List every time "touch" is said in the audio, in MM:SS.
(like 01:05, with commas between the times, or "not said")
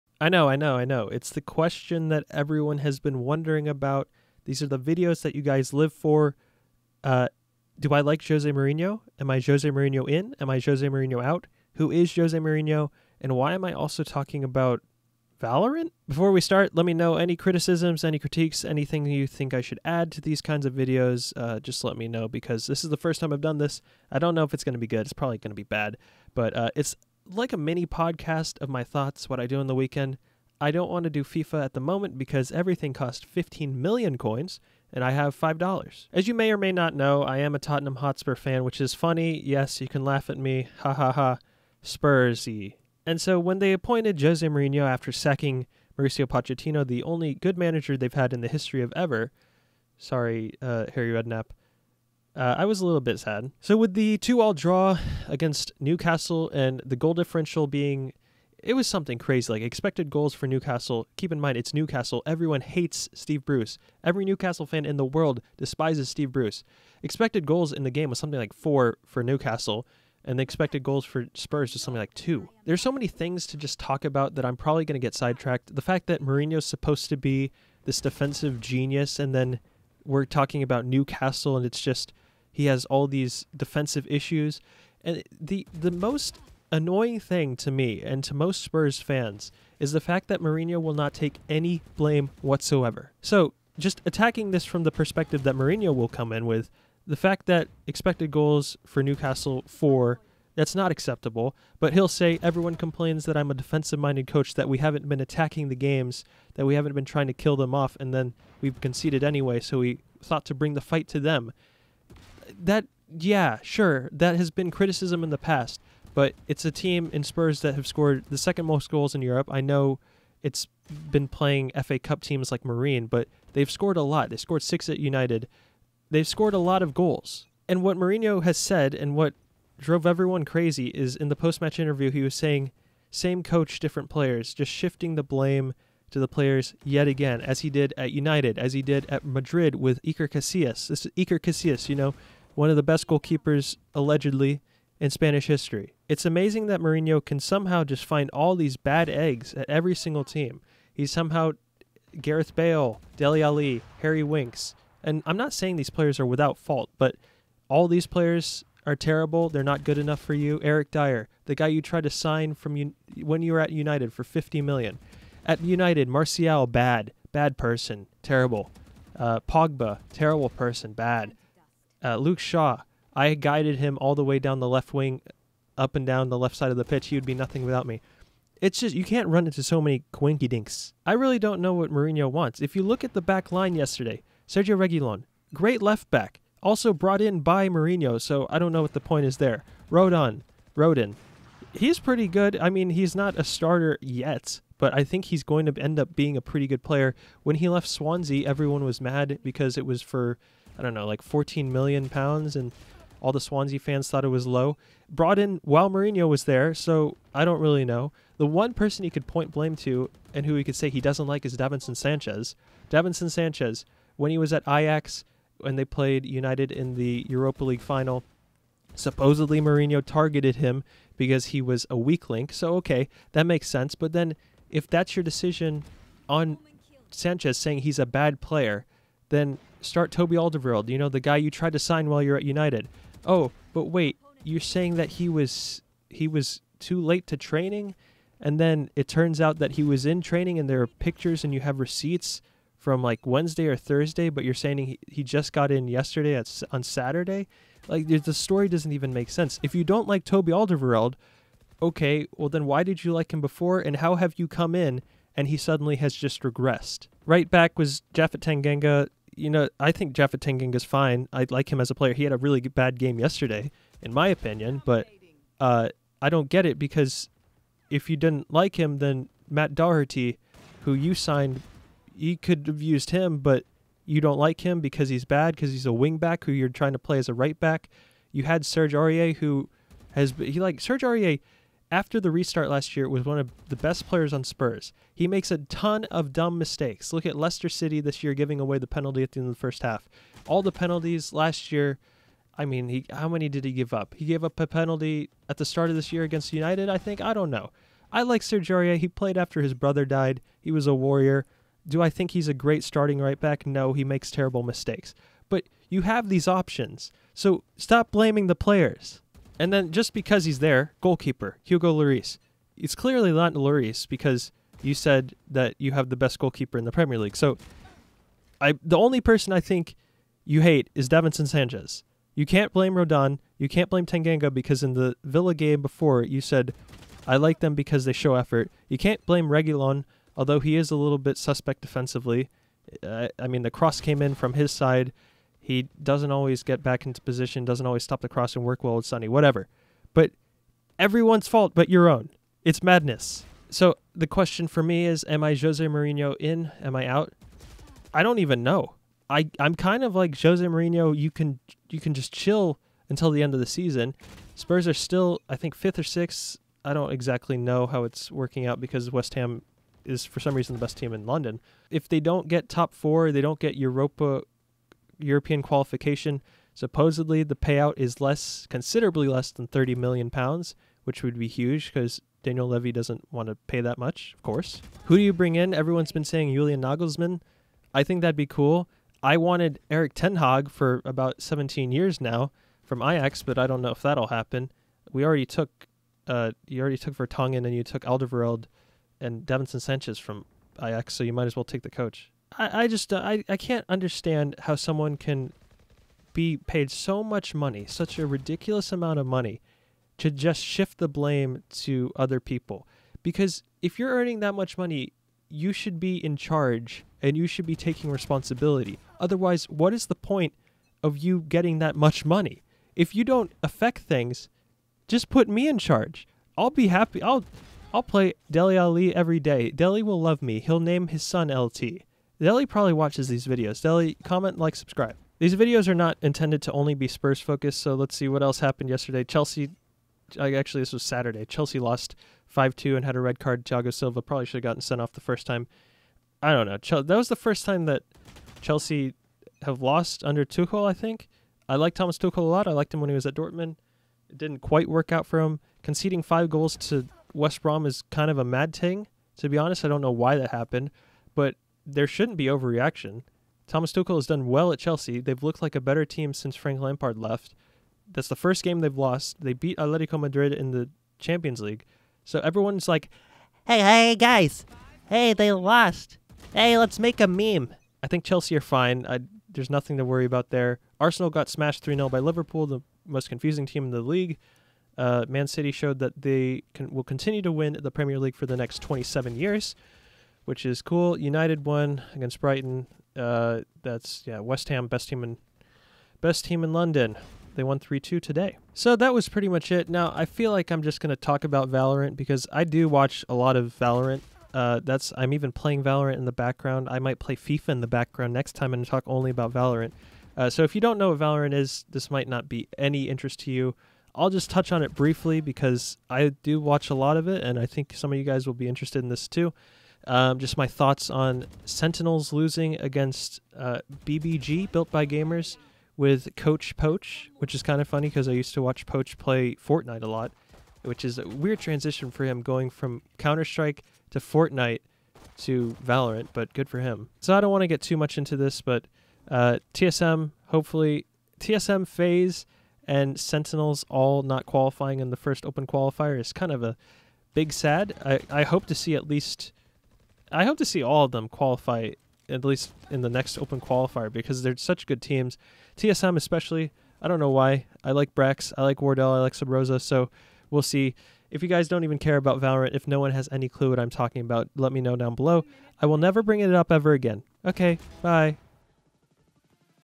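08:24.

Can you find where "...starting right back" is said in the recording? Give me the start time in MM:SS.
05:02.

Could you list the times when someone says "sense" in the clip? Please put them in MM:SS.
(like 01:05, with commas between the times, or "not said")
03:43, 04:09.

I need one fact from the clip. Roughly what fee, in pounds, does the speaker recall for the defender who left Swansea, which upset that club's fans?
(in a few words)
14 million pounds.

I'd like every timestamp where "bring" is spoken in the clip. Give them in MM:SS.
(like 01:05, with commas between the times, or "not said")
01:50, 06:15, 09:16.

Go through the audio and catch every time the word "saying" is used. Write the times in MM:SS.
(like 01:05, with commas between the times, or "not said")
02:12, 02:35, 03:47, 03:54, 04:04, 06:16.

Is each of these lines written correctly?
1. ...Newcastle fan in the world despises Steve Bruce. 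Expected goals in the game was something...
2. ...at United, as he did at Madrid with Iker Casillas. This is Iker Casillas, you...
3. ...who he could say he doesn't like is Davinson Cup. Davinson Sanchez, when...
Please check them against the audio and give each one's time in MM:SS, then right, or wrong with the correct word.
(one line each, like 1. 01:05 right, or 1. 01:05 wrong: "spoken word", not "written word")
1. 01:04 right
2. 02:17 right
3. 03:30 wrong: "Sanchez", not "Cup".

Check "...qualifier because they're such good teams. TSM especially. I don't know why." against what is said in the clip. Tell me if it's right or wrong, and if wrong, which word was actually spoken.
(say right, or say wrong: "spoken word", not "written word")
right.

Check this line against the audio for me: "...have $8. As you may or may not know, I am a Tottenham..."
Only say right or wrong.
wrong.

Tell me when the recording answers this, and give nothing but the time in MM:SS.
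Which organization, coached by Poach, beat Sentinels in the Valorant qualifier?
08:34.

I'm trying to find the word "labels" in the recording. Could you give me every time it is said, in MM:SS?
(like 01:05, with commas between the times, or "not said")
not said.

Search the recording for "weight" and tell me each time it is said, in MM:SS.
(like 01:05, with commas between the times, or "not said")
not said.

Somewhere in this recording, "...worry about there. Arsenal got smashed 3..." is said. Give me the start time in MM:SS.
07:50.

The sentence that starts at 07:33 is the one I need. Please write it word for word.
Thomas Tuchel has done well at Chelsea.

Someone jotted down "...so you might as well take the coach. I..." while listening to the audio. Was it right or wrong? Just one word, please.
right.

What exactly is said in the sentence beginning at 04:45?
He makes a ton of dumb mistakes.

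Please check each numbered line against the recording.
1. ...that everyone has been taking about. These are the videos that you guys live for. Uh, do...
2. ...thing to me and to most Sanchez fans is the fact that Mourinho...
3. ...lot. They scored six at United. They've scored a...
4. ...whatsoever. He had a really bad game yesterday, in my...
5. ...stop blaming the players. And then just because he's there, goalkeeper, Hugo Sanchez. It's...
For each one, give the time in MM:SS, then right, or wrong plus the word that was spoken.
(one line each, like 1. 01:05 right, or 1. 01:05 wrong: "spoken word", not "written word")
1. 00:02 wrong: "wondering", not "taking"
2. 01:27 wrong: "Spurs", not "Sanchez"
3. 02:04 right
4. 04:21 wrong: "player", not "whatsoever"
5. 05:07 wrong: "Lloris", not "Sanchez".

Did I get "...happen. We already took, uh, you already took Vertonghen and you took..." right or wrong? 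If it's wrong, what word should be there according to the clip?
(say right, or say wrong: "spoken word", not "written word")
right.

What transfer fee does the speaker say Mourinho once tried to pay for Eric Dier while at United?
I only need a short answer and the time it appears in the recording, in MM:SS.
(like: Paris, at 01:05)
50 million, at 02:44.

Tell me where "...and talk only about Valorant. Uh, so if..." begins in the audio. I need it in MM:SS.
08:18.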